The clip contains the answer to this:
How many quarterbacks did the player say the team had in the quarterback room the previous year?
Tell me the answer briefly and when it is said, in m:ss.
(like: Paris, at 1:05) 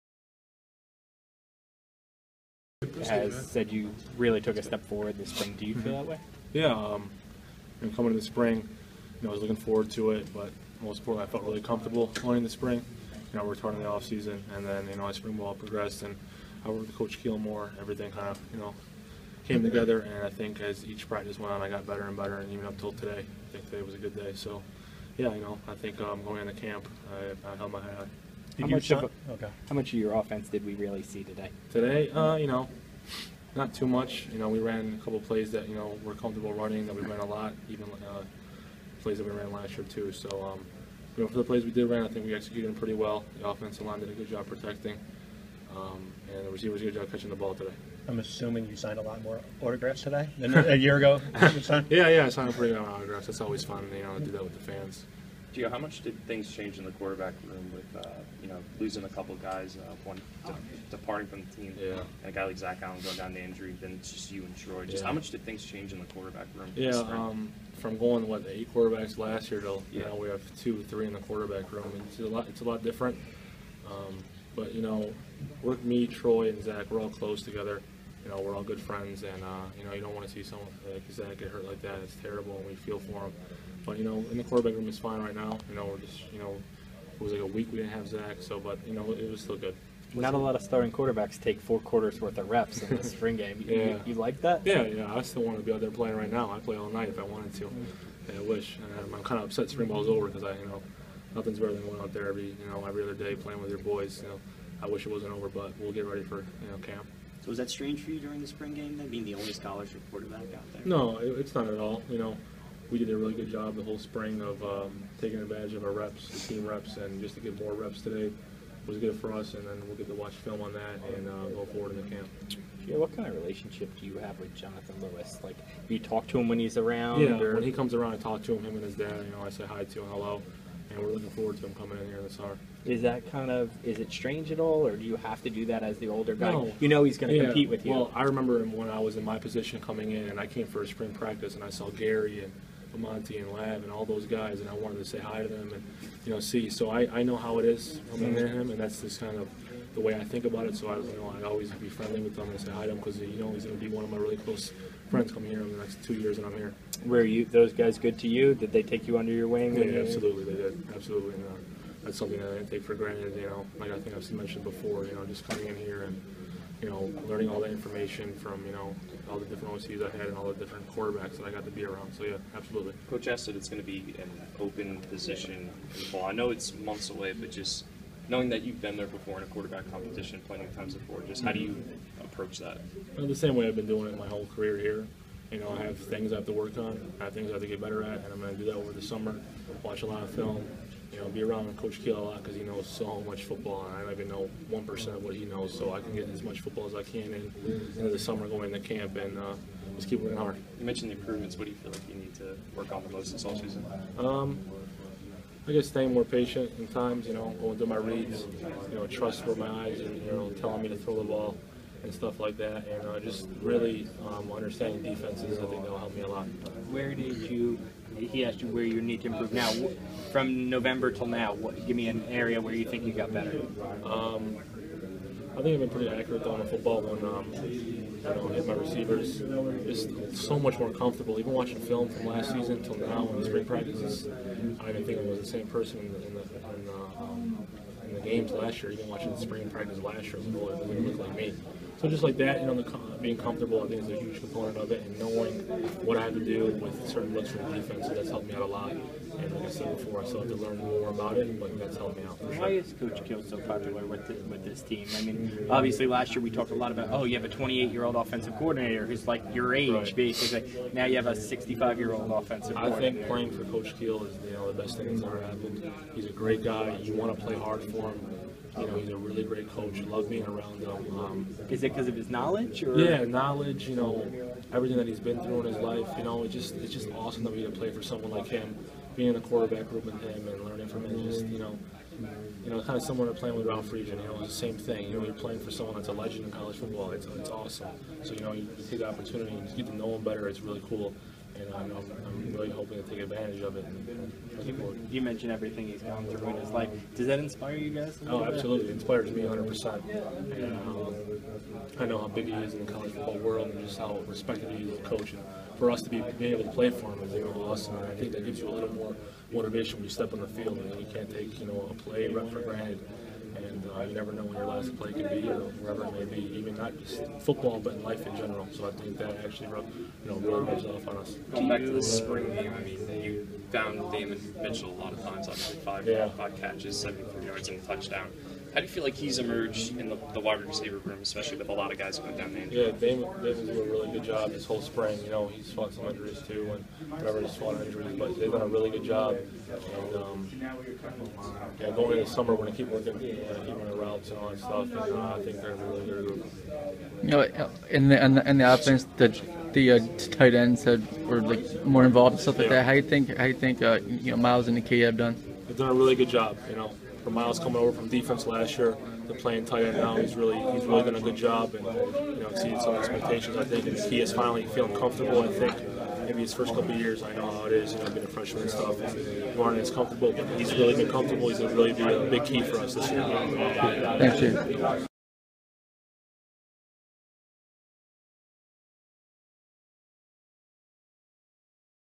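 8, at 1:08.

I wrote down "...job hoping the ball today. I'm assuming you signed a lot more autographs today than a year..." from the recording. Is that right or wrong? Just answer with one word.
wrong.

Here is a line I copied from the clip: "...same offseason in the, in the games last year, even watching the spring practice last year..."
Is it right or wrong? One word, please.
wrong.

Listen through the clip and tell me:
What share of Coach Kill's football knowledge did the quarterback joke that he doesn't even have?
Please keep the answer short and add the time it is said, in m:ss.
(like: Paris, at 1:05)
1%, at 3:14.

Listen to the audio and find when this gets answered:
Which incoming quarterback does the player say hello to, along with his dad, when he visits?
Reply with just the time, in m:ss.
2:04.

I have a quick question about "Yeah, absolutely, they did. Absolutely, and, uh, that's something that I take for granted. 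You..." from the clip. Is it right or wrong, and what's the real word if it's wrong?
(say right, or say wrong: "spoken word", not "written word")
right.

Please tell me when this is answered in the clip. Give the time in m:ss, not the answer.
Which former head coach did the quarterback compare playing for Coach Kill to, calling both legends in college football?
4:43.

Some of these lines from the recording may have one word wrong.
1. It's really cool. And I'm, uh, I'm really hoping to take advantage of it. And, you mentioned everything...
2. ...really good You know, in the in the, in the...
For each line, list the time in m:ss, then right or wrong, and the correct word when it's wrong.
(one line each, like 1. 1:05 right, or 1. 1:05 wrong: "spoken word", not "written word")
1. 4:50 right
2. 5:45 right.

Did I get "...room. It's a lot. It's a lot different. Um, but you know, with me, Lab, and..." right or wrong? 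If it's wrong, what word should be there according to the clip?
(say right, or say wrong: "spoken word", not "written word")
wrong: "Troy", not "Lab".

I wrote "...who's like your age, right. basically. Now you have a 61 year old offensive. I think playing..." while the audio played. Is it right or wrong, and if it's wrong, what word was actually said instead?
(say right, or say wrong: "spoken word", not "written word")
wrong: "65", not "61".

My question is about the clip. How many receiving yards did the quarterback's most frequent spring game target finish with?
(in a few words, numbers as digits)
73.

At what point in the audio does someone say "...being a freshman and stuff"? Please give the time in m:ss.
6:08.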